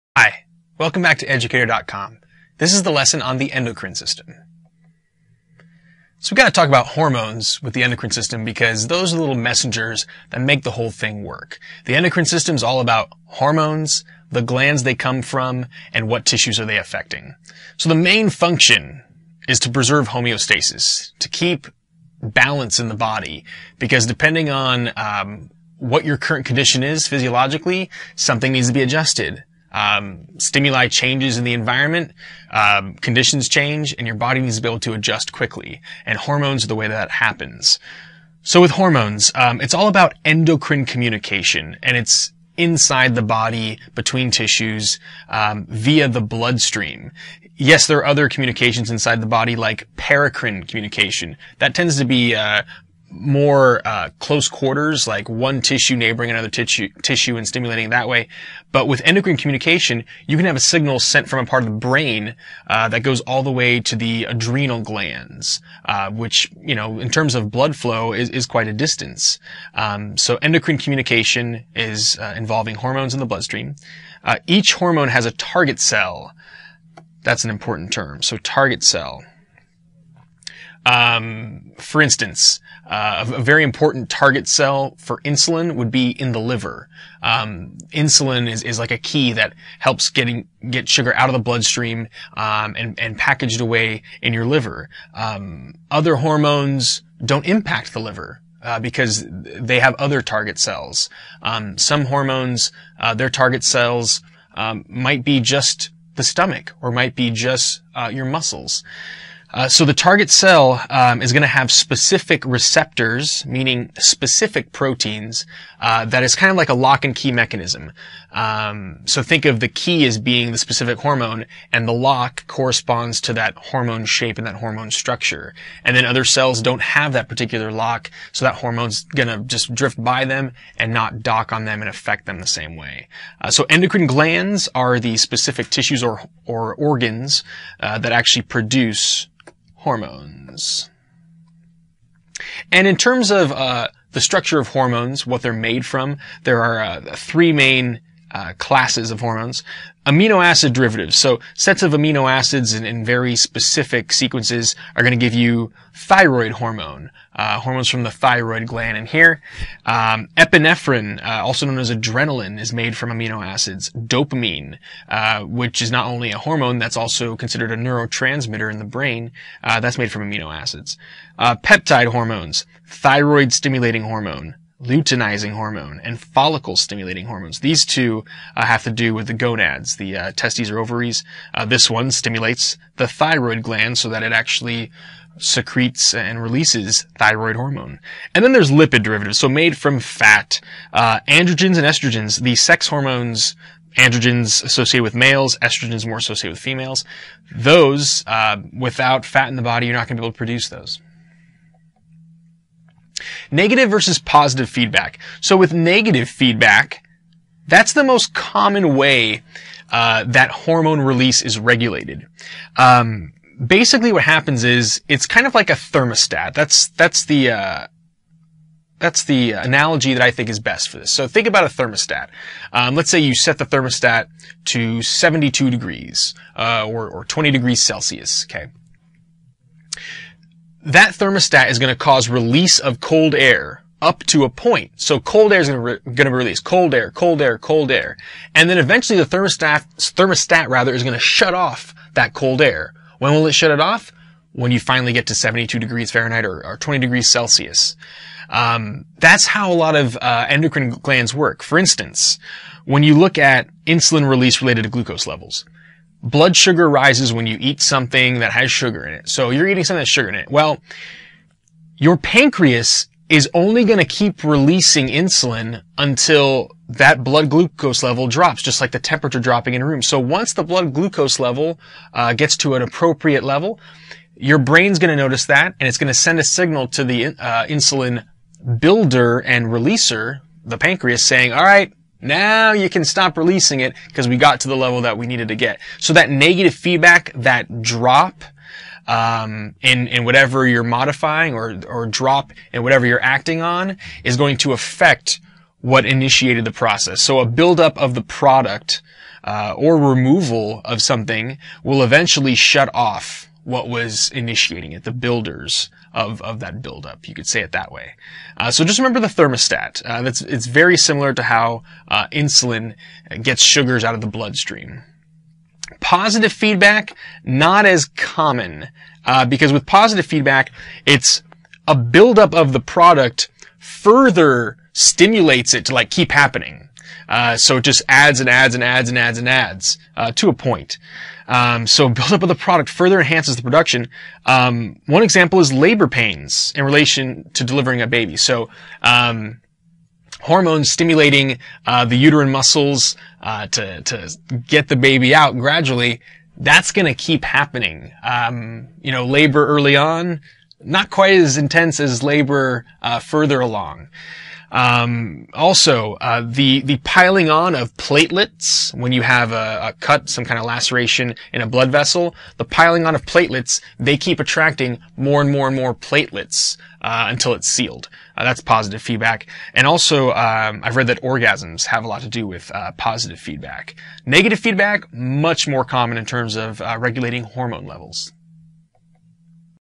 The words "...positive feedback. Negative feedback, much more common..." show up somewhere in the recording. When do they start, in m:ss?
6:12.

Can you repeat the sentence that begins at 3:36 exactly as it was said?
That's that's the uh, that's the analogy that I think is best for this.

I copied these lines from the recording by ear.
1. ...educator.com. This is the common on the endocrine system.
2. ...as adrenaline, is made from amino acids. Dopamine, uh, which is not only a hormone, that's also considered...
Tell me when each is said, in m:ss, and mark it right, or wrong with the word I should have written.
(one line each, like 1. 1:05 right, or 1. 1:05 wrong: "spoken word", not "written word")
1. 0:01 wrong: "lesson", not "common"
2. 2:41 right.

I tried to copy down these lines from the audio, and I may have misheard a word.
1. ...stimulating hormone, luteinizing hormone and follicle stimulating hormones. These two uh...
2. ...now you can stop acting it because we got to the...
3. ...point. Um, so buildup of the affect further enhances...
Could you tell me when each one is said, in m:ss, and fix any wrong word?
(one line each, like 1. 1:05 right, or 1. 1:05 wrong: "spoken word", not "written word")
1. 2:53 right
2. 4:42 wrong: "releasing", not "acting"
3. 5:30 wrong: "product", not "affect".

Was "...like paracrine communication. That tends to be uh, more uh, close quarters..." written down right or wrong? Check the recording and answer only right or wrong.
right.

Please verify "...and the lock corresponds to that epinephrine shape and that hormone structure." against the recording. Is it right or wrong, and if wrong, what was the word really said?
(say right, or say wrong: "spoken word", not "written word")
wrong: "hormone", not "epinephrine".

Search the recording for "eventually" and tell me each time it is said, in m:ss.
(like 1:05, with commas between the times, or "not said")
3:58, 5:02.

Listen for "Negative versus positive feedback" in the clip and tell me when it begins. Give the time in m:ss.
3:23.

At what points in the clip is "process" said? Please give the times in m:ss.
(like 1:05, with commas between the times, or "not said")
4:56.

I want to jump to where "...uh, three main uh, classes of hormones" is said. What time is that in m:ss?
2:26.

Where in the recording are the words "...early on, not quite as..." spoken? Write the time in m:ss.
5:49.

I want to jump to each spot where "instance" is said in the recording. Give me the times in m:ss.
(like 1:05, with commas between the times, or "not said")
1:22, 4:11.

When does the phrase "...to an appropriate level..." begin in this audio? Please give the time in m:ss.
4:32.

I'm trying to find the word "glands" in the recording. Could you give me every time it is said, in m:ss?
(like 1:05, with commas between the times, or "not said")
0:14, 1:04, 2:14, 2:38, 3:03, 4:10.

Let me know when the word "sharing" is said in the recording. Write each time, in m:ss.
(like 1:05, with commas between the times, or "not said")
not said.